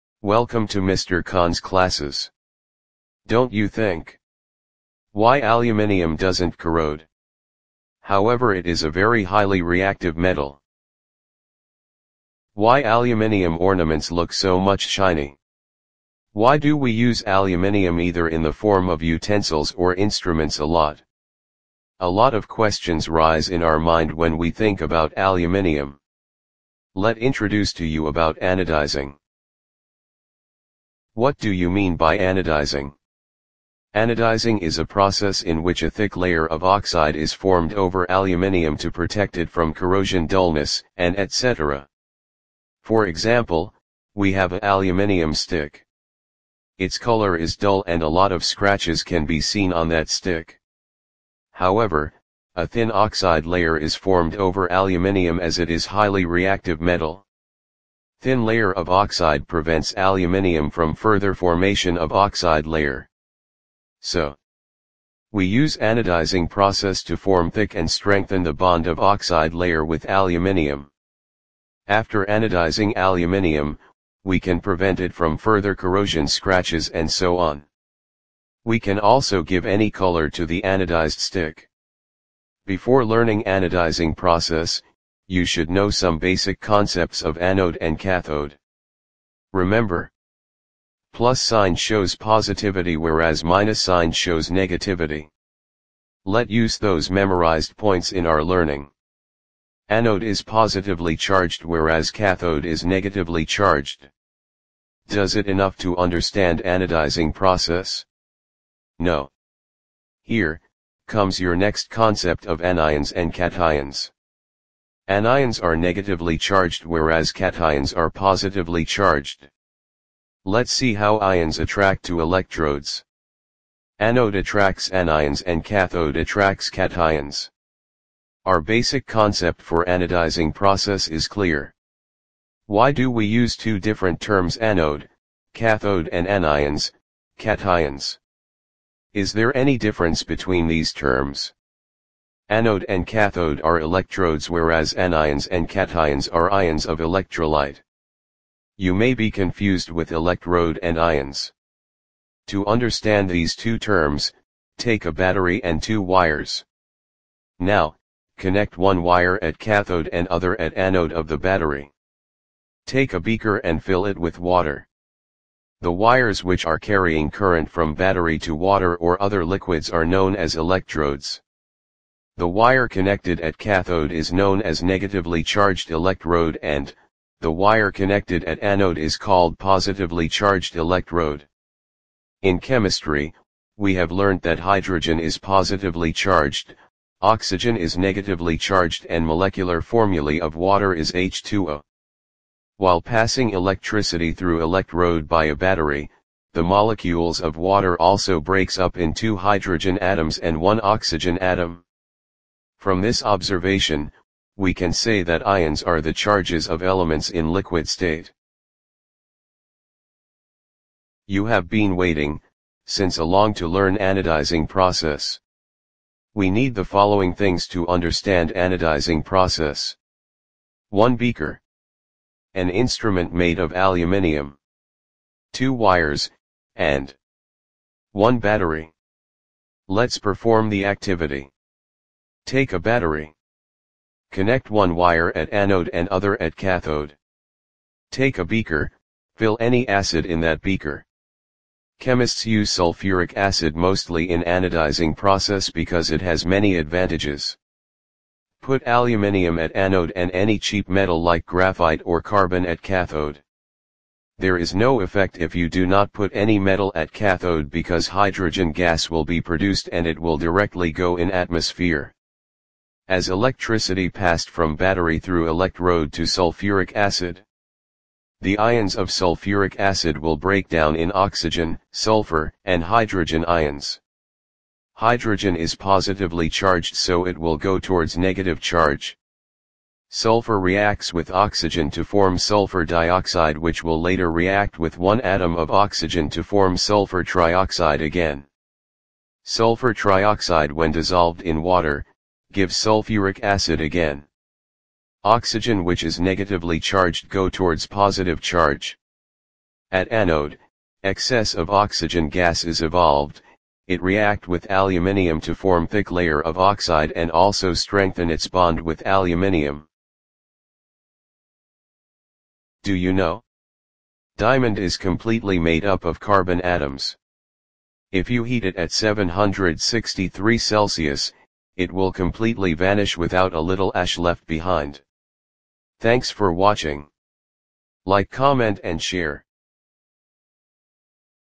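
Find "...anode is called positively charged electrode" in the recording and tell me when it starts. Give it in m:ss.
2:58.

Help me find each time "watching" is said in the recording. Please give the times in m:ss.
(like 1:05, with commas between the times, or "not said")
5:26.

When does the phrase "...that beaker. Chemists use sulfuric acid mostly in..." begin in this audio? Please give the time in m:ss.
4:00.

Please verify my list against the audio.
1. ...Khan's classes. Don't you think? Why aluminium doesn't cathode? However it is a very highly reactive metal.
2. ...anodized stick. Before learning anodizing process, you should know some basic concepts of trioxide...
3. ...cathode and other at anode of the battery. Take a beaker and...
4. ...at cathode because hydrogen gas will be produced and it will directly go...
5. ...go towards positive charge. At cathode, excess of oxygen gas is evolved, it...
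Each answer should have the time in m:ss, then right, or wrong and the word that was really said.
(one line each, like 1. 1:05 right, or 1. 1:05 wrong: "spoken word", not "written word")
1. 0:01 wrong: "corrode", not "cathode"
2. 1:20 wrong: "anode", not "trioxide"
3. 2:39 right
4. 4:16 right
5. 4:57 wrong: "anode", not "cathode".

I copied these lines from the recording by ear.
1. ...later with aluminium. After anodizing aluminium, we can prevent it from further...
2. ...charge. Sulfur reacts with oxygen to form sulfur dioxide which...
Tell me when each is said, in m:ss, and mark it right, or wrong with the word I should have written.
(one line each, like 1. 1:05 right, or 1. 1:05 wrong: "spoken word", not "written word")
1. 1:09 wrong: "layer", not "later"
2. 4:38 right.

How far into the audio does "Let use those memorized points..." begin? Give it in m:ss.
1:36.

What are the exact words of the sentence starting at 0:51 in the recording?
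However, a thin oxide layer is formed over aluminium as it is highly reactive metal.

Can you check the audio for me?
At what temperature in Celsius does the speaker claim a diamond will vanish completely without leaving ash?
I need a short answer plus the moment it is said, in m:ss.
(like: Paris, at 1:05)
763, at 5:18.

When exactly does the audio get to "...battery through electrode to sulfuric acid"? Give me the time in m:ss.
4:24.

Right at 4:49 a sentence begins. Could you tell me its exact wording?
Sulfur trioxide when dissolved in water, give sulfuric acid again.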